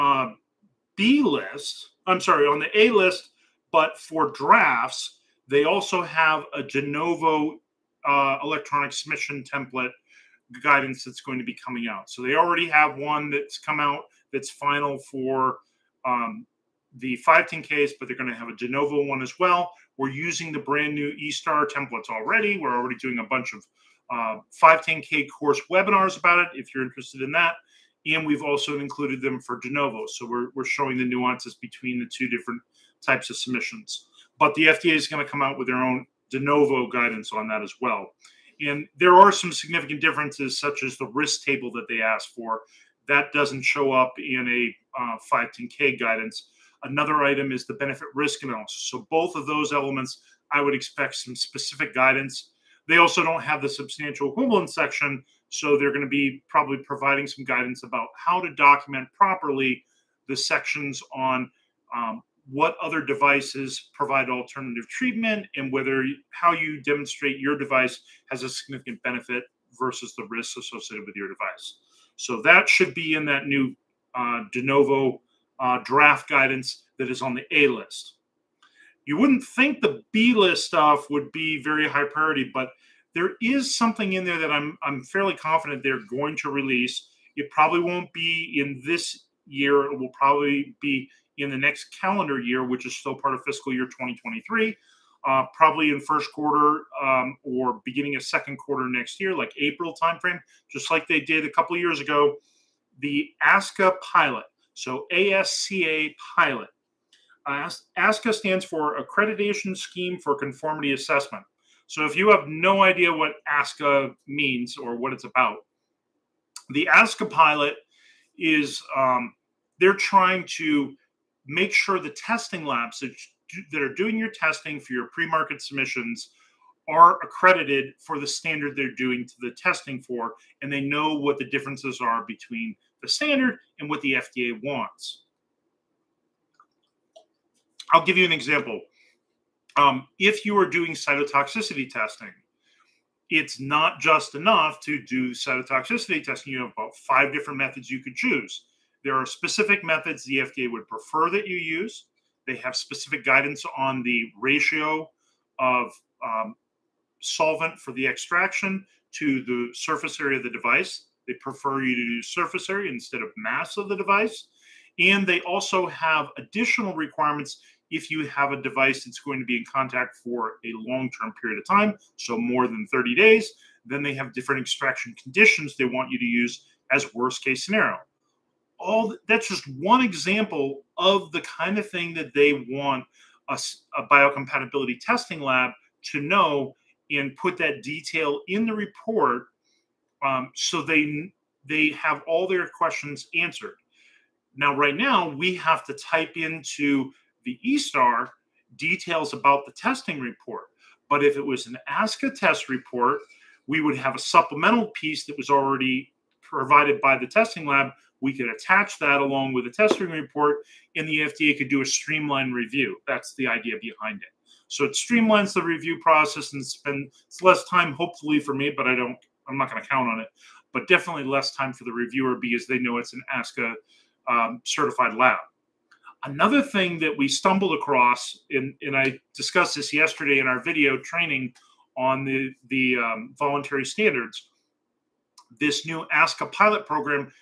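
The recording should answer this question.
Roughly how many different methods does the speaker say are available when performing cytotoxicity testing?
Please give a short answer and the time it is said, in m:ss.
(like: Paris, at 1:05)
5, at 2:26.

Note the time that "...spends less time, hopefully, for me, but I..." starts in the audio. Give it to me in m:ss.
3:36.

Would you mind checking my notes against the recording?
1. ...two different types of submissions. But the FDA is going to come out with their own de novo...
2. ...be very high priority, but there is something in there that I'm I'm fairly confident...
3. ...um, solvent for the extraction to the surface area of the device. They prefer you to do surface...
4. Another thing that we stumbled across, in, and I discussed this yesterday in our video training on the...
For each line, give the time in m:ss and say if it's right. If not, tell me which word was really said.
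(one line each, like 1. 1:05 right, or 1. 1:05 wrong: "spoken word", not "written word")
1. 0:32 right
2. 1:21 right
3. 2:36 right
4. 3:46 right.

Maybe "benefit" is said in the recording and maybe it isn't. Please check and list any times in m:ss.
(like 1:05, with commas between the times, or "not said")
0:47, 1:09.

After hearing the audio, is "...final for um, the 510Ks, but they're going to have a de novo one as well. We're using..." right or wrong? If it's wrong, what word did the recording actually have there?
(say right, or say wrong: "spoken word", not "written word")
right.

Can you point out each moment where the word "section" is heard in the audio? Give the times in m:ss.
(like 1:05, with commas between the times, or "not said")
0:54, 1:00.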